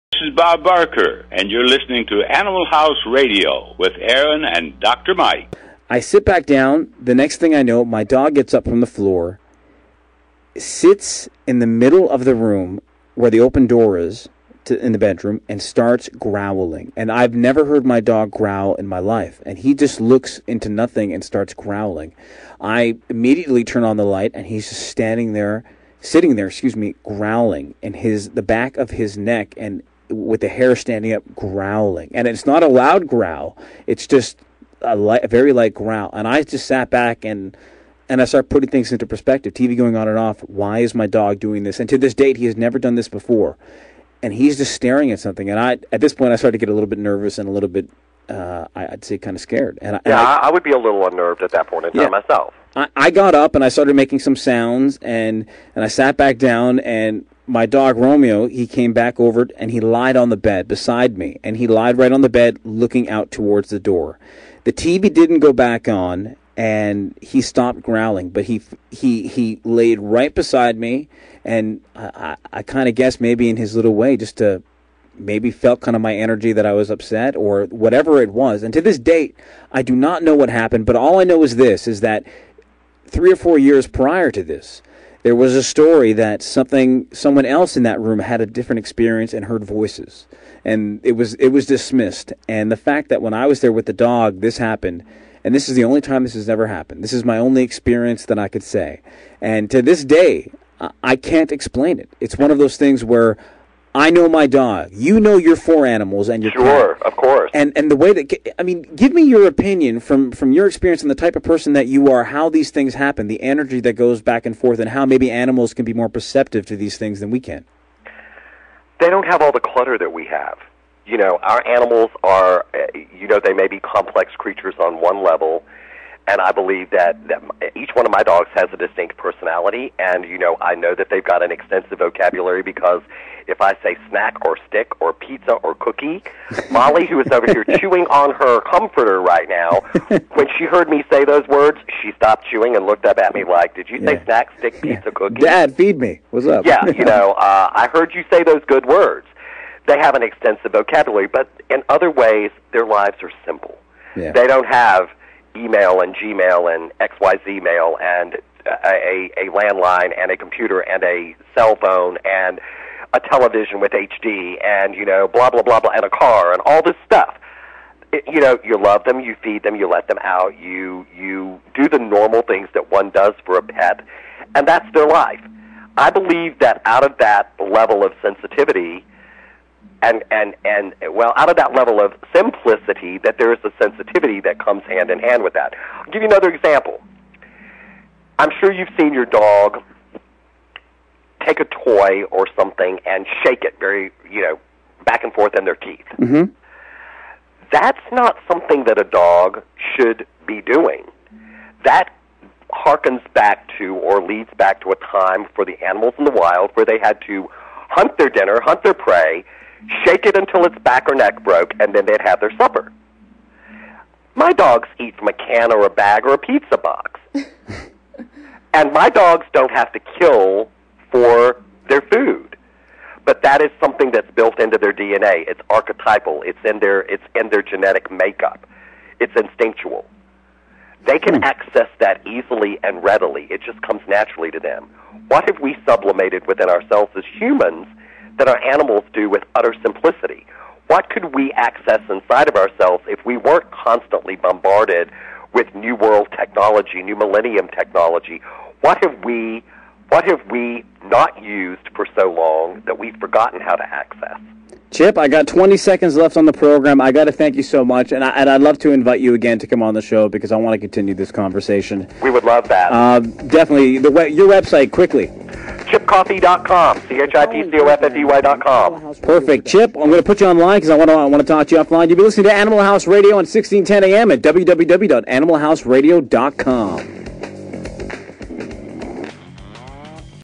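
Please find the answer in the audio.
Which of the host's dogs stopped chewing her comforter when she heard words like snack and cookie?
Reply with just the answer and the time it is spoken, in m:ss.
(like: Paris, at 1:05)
Molly, at 2:16.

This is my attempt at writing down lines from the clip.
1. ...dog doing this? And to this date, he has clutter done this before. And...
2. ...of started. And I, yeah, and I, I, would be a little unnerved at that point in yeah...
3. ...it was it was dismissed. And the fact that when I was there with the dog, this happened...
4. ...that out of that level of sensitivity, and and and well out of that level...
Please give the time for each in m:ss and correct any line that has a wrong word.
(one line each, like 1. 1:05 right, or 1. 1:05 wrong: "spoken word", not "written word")
1. 0:41 wrong: "never", not "clutter"
2. 0:49 wrong: "scared", not "started"
3. 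1:31 right
4. 2:56 right.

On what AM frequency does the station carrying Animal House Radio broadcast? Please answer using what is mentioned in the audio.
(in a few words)
1610.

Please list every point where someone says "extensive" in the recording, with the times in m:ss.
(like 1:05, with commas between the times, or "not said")
2:11, 2:30.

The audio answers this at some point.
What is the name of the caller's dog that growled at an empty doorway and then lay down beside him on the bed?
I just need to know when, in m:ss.
0:57.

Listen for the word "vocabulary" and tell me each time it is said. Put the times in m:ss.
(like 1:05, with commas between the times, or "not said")
2:11, 2:30.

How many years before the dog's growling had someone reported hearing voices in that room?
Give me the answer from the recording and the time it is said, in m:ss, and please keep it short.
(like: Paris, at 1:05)
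3 or 4, at 1:23.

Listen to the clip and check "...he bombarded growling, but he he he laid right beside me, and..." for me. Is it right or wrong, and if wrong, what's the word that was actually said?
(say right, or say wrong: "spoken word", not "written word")
wrong: "stopped", not "bombarded".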